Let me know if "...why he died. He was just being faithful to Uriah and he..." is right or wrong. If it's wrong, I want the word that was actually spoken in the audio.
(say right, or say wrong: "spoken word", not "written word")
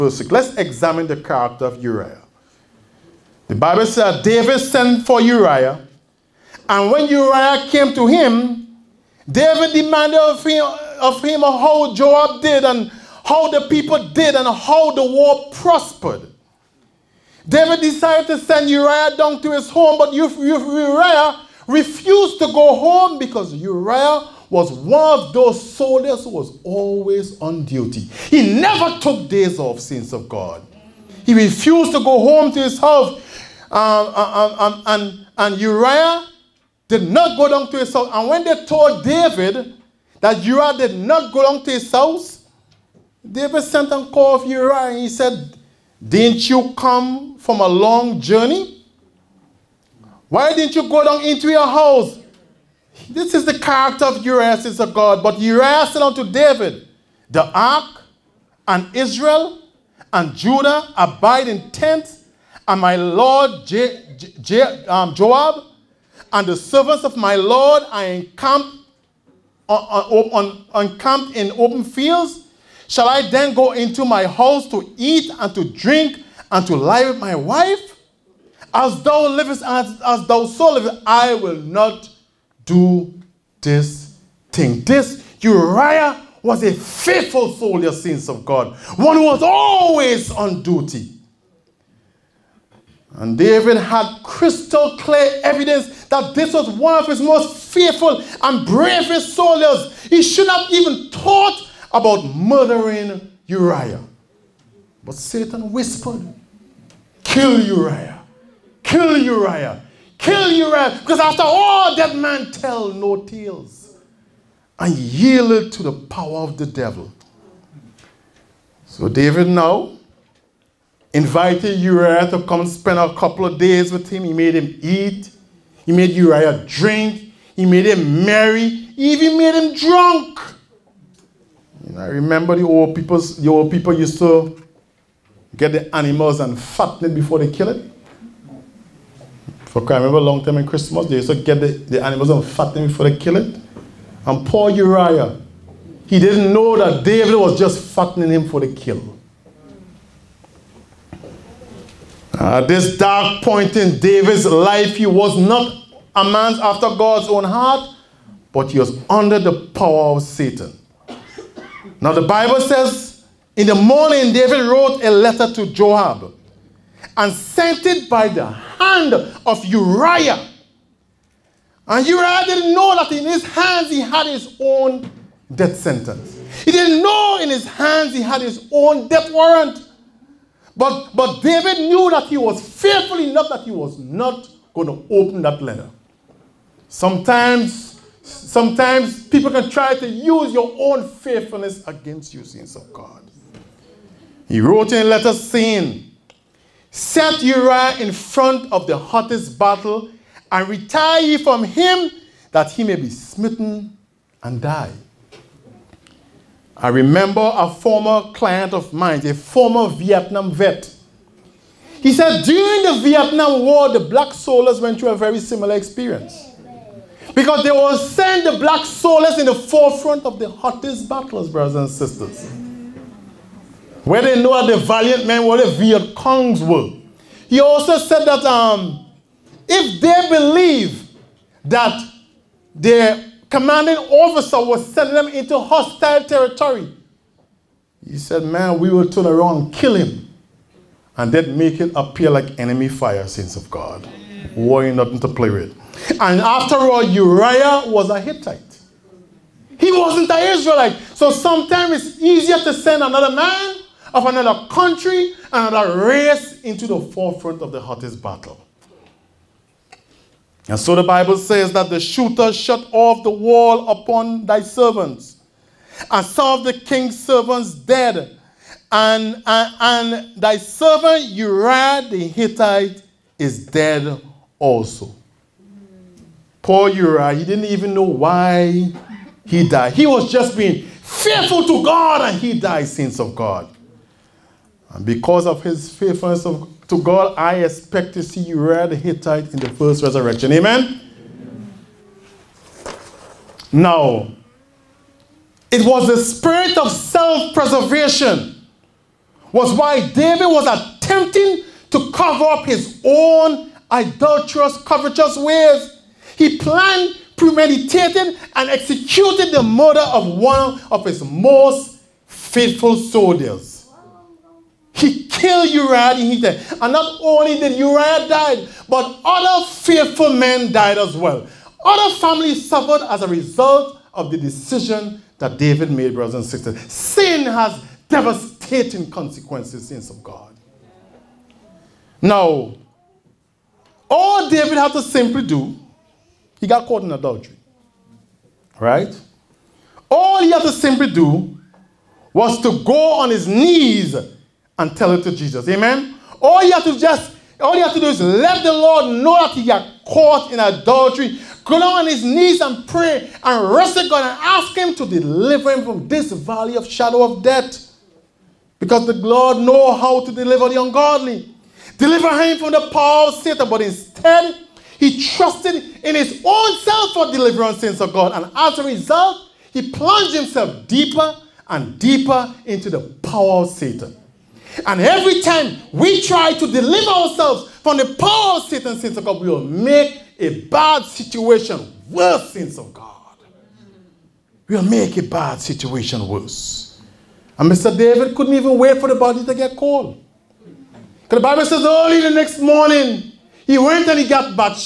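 wrong: "God", not "Uriah".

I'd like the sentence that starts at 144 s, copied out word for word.
And poor Uriah, he didn't know that David was just fattening him for the kill.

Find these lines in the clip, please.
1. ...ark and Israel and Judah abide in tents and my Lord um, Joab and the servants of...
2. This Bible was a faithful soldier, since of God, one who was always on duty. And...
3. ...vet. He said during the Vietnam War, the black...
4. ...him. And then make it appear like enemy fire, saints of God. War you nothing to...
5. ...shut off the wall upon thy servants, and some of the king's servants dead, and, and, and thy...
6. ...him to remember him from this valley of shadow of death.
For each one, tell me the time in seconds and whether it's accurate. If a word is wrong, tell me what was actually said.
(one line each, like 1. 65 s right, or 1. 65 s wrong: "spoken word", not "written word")
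1. 57 s right
2. 84 s wrong: "Uriah", not "Bible"
3. 210 s right
4. 239 s right
5. 262 s right
6. 354 s wrong: "deliver", not "remember".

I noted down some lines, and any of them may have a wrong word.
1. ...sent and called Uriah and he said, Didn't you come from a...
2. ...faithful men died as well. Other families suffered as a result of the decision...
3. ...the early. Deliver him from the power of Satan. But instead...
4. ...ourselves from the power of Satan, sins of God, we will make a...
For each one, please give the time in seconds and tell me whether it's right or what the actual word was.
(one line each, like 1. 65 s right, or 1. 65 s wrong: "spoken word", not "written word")
1. 43 s right
2. 319 s right
3. 360 s wrong: "ungodly", not "early"
4. 377 s right.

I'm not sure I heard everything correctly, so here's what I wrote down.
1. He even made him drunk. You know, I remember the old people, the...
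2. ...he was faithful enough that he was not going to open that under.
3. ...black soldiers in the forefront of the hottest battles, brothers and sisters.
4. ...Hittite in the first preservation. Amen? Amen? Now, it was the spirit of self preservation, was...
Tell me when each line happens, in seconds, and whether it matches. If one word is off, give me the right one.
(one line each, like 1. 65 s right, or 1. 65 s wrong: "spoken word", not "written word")
1. 128 s right
2. 182 s wrong: "letter", not "under"
3. 218 s right
4. 288 s wrong: "resurrection", not "preservation".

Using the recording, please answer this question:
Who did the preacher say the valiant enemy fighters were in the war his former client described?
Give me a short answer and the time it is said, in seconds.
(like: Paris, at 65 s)
the Viet Congs, at 225 s.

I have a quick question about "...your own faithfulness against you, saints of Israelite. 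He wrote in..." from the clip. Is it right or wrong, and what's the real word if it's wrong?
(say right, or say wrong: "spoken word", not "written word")
wrong: "God", not "Israelite".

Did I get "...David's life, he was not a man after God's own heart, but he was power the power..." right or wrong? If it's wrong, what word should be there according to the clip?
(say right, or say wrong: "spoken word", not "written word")
wrong: "under", not "power".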